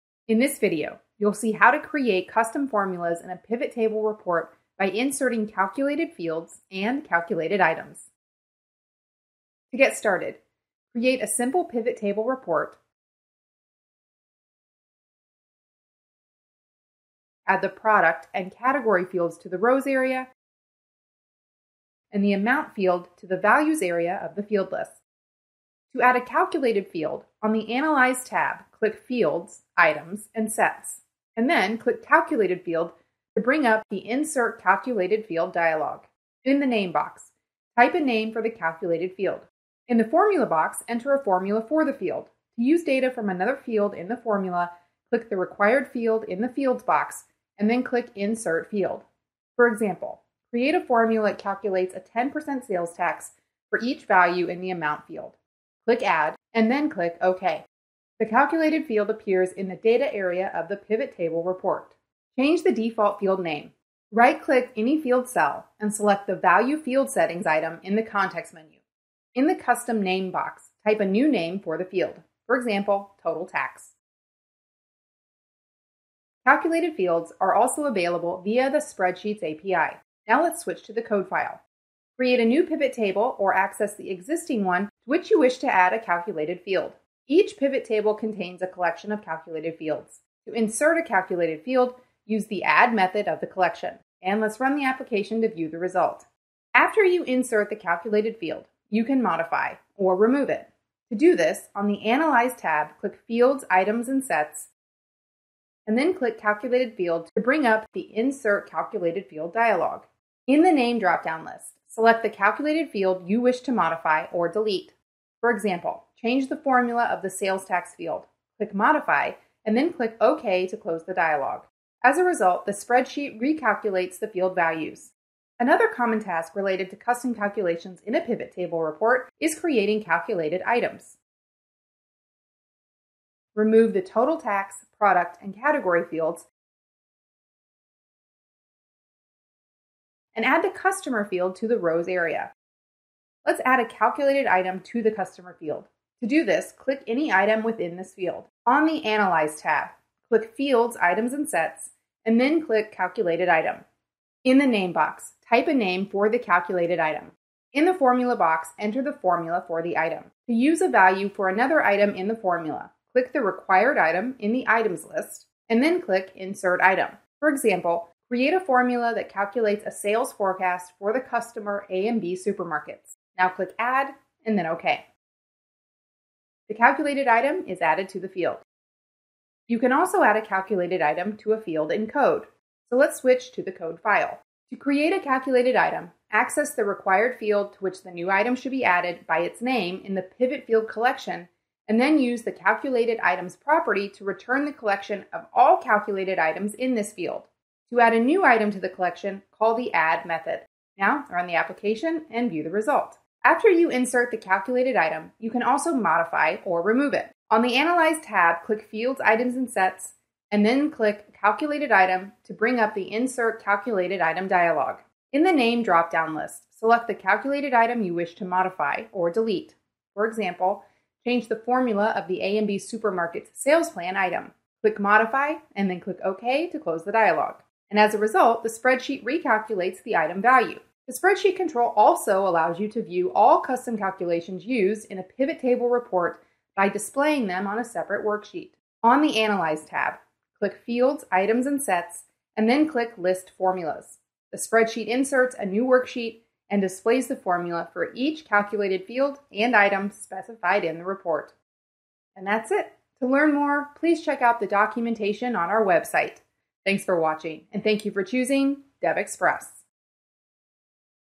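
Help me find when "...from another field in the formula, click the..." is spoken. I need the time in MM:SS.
00:43.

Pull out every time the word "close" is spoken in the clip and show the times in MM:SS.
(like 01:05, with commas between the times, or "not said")
02:00, 03:46.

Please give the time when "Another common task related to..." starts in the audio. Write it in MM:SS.
02:05.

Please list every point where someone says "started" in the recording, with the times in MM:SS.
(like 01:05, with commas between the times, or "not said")
00:09.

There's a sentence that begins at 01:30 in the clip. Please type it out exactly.
To insert a calculated field, use the add method of the collection.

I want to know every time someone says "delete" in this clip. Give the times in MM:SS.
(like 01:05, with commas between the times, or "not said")
01:54, 03:39.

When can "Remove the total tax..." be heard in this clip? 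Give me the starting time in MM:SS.
02:13.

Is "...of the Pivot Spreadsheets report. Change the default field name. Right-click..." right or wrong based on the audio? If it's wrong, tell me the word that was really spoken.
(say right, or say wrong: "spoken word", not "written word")
wrong: "Table", not "Spreadsheets".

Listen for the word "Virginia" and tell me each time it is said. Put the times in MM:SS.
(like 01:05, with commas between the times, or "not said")
not said.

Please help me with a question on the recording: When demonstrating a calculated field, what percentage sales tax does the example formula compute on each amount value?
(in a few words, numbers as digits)
10%.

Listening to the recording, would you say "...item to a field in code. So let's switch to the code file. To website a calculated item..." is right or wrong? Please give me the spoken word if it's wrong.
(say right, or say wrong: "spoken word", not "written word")
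wrong: "create", not "website".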